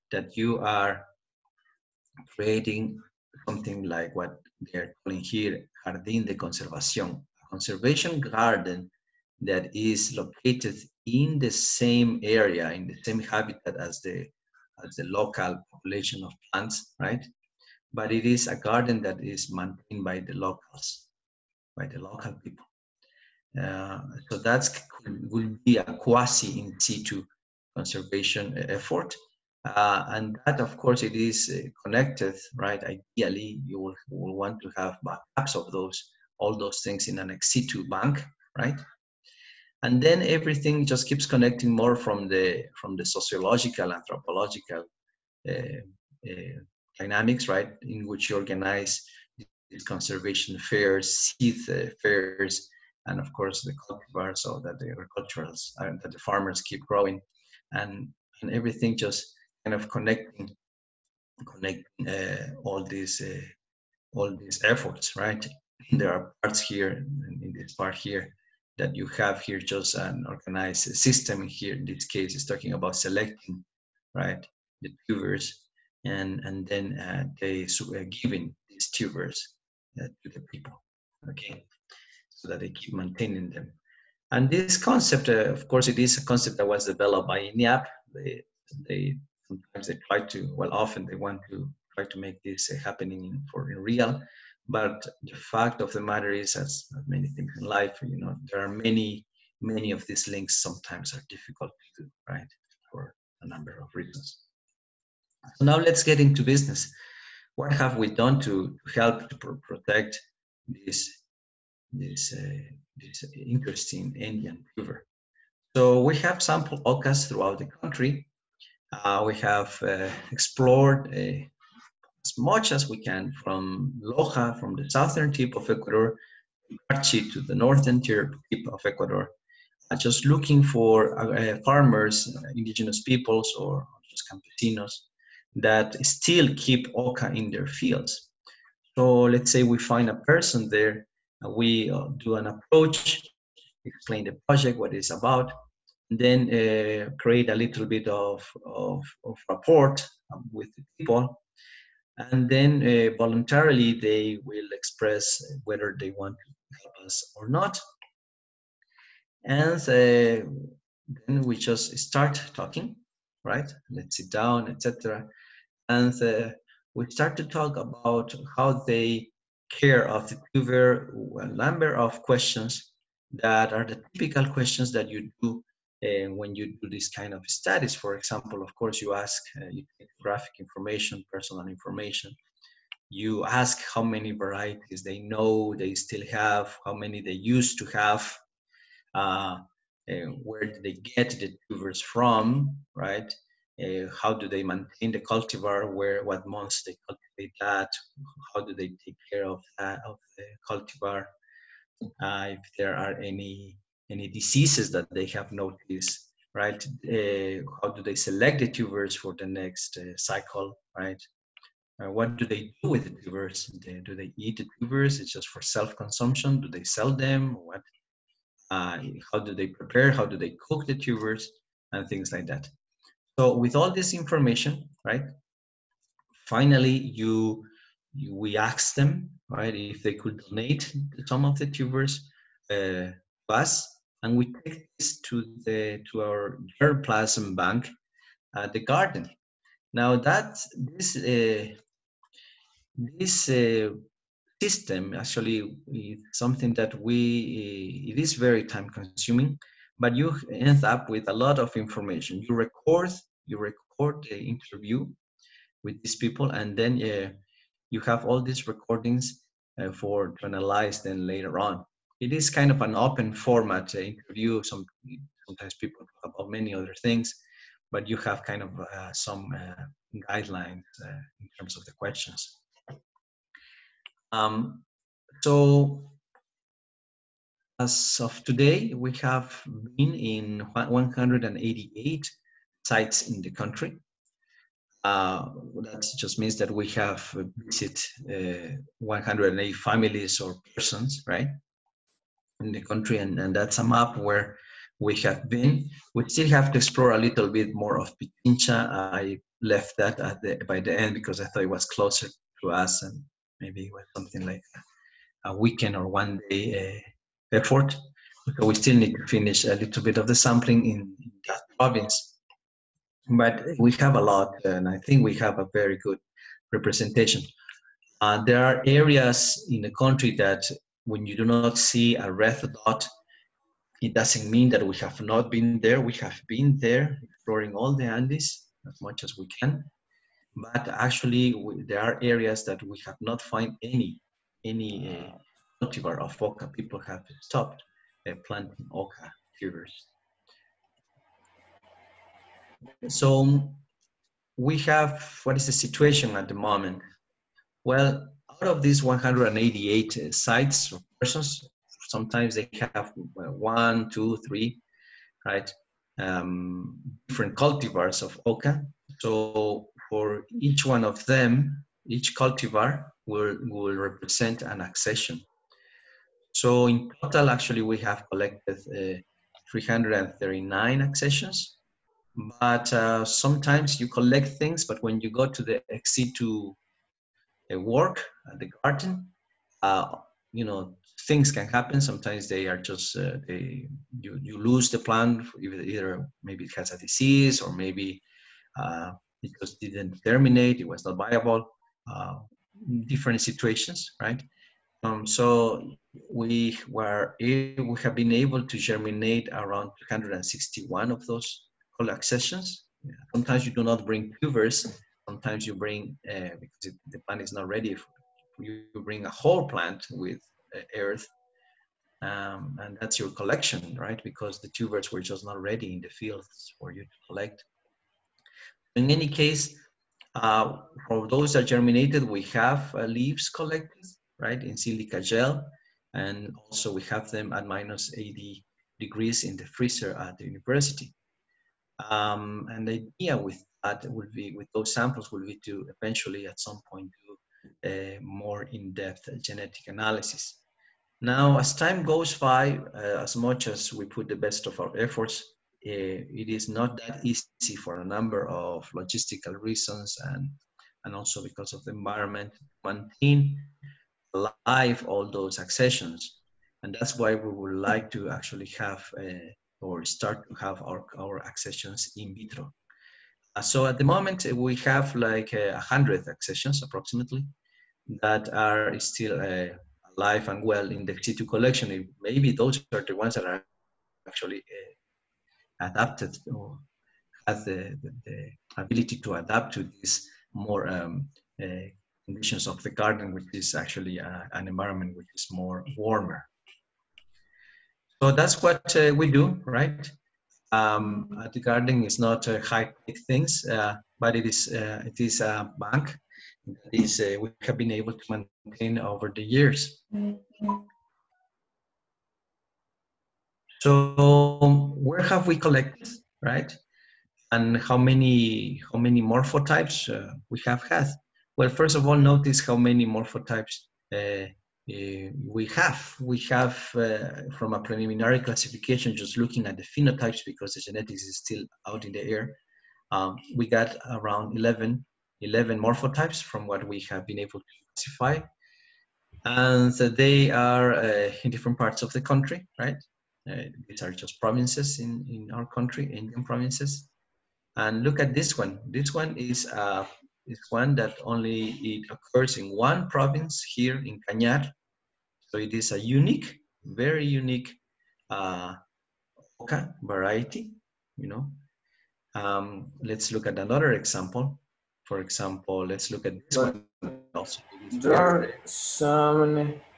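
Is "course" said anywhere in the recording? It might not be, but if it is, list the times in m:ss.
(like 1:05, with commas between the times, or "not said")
0:30, 0:53, 1:25, 2:58.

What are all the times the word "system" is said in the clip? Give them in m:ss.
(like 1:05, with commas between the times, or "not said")
1:10, 4:04.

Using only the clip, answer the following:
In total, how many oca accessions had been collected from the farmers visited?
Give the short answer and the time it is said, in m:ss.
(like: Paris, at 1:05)
339, at 6:09.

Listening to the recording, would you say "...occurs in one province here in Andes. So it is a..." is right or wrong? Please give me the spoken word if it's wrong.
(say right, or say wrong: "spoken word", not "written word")
wrong: "Cañar", not "Andes".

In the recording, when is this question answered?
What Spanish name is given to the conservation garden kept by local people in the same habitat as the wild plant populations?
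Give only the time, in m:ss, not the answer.
0:05.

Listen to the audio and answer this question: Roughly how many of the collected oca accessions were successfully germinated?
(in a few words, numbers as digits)
261.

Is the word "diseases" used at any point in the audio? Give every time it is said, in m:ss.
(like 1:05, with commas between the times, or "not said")
3:24, 6:26.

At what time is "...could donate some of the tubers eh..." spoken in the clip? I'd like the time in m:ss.
3:50.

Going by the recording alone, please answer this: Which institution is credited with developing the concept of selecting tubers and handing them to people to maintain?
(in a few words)
INIAP.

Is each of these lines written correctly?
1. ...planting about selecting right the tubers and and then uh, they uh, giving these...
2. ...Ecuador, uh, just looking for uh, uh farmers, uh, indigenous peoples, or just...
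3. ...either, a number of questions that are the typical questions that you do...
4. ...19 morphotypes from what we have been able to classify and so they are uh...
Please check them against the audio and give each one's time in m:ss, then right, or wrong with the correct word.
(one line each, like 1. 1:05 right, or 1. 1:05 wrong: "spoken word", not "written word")
1. 1:12 wrong: "talking", not "planting"
2. 2:08 right
3. 2:50 wrong: "tuber", not "either"
4. 8:45 wrong: "11", not "19".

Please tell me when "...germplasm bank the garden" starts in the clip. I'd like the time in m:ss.
3:56.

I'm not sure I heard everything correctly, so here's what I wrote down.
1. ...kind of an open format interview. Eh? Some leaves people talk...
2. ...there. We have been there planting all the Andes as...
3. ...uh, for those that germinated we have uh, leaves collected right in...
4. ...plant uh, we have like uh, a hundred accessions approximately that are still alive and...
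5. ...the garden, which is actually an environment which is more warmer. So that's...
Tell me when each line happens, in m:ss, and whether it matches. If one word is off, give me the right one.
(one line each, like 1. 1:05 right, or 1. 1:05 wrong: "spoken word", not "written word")
1. 4:22 wrong: "sometimes", not "leaves"
2. 5:25 wrong: "exploring", not "planting"
3. 7:00 right
4. 7:44 wrong: "moment", not "plant"
5. 8:02 right.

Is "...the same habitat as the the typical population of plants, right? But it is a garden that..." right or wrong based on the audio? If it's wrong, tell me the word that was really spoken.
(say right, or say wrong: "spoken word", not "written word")
wrong: "local", not "typical".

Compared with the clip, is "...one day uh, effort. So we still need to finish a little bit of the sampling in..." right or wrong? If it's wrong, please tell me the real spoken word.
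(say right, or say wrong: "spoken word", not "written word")
right.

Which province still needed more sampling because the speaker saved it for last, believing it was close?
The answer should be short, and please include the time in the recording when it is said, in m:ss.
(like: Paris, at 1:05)
Pichincha, at 4:58.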